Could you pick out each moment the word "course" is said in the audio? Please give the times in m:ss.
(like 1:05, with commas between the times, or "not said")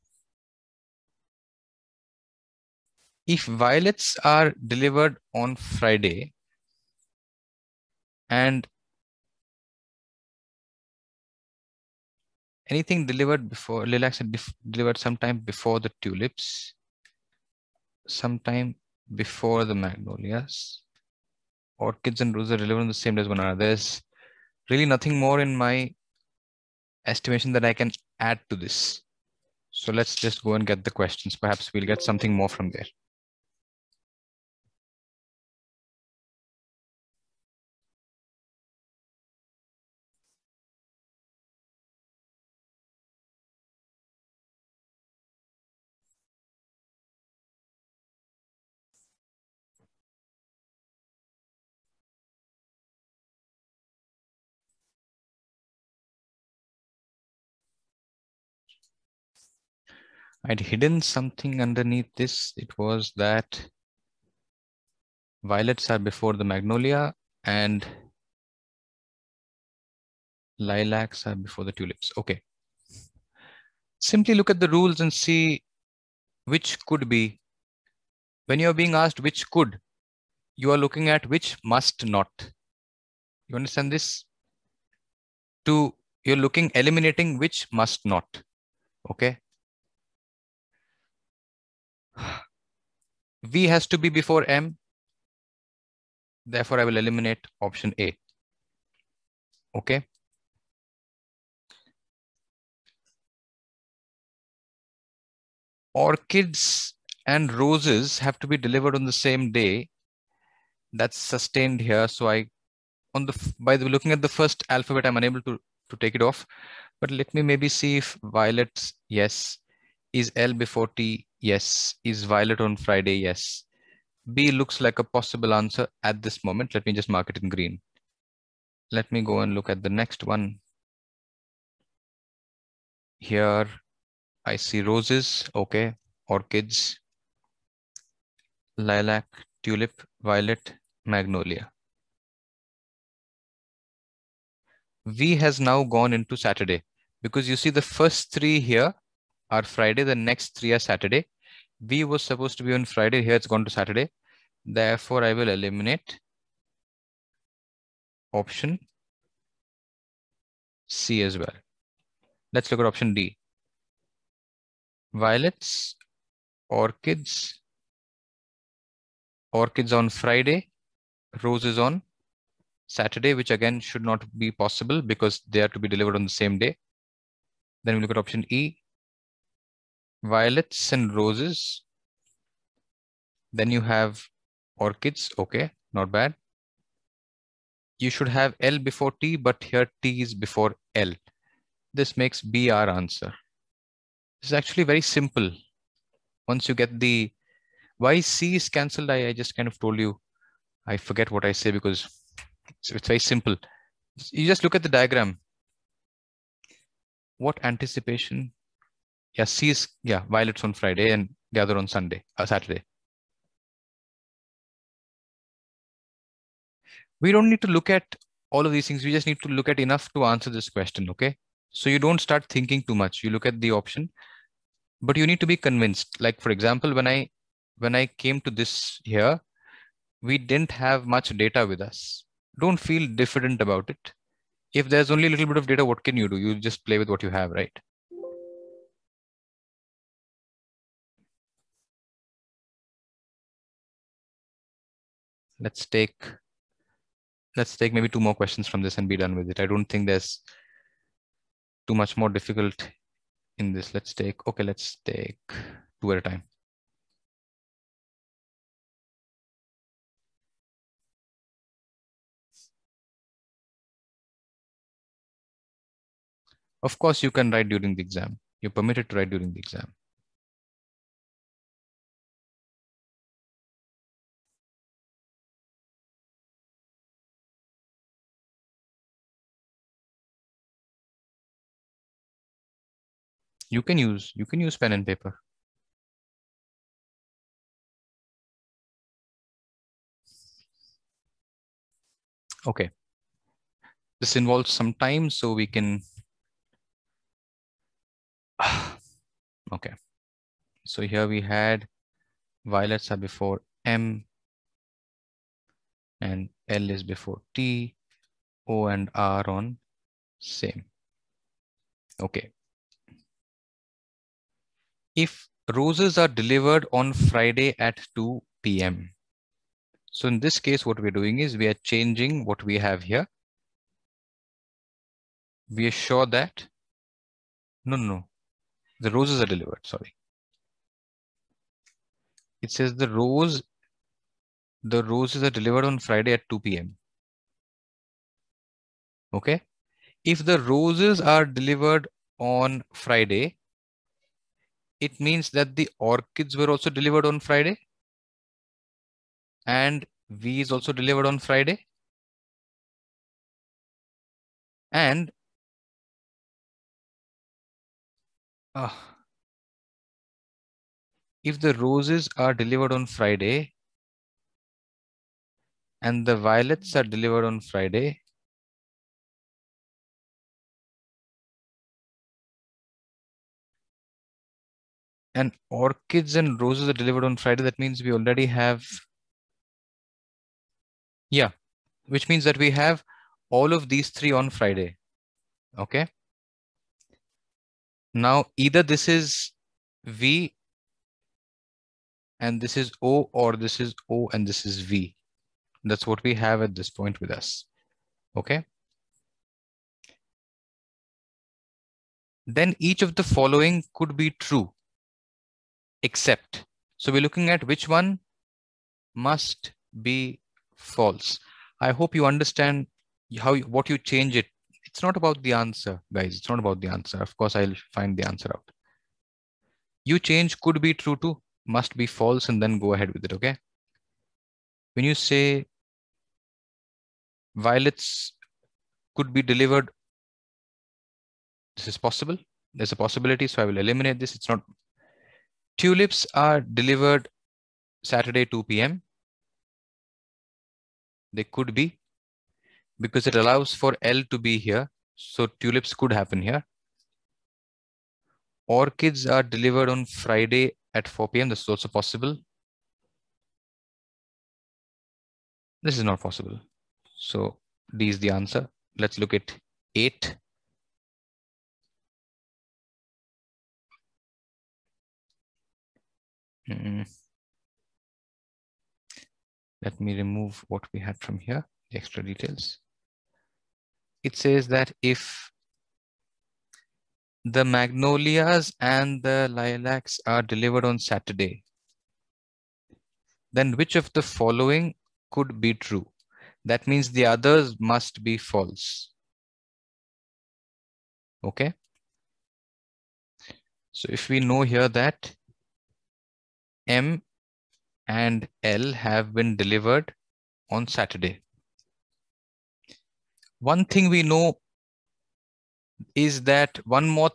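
4:26, 6:57.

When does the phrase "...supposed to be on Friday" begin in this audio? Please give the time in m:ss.
2:32.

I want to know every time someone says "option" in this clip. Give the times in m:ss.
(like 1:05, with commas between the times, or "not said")
1:37, 2:38, 2:42, 2:58, 3:43.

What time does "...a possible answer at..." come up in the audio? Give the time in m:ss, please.
2:04.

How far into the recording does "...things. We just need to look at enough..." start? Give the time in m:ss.
3:38.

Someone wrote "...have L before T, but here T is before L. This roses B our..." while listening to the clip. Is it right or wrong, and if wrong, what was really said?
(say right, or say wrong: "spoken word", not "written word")
wrong: "makes", not "roses".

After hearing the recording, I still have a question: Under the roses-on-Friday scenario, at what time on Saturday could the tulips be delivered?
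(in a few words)
2 p.m.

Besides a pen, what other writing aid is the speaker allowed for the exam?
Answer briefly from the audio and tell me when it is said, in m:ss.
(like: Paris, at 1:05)
Paper, at 4:45.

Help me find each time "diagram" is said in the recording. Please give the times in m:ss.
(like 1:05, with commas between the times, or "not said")
3:24.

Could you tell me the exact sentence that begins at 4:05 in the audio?
let's take let's take maybe two more questions from this and be done with it.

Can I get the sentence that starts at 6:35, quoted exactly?
That's what we have at this point with us.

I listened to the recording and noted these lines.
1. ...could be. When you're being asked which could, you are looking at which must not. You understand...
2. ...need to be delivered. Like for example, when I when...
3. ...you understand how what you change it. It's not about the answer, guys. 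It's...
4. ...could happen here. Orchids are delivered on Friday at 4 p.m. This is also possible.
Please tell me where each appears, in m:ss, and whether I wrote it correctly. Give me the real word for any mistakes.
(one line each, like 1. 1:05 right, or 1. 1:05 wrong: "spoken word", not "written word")
1. 1:16 right
2. 3:45 wrong: "convinced", not "delivered"
3. 6:52 right
4. 7:25 right.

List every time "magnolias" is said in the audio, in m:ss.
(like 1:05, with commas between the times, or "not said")
0:19, 1:06, 2:21, 7:57.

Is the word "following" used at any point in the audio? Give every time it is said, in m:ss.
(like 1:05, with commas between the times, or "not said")
6:43, 8:04.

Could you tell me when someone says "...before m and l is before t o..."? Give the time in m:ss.
5:03.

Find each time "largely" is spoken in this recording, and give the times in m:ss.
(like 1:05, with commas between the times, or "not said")
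not said.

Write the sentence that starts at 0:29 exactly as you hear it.
So let's just go and get the questions.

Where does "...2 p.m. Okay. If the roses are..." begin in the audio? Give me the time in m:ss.
5:36.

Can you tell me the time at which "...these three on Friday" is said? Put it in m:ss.
6:23.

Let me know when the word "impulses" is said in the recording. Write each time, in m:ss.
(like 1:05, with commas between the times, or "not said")
not said.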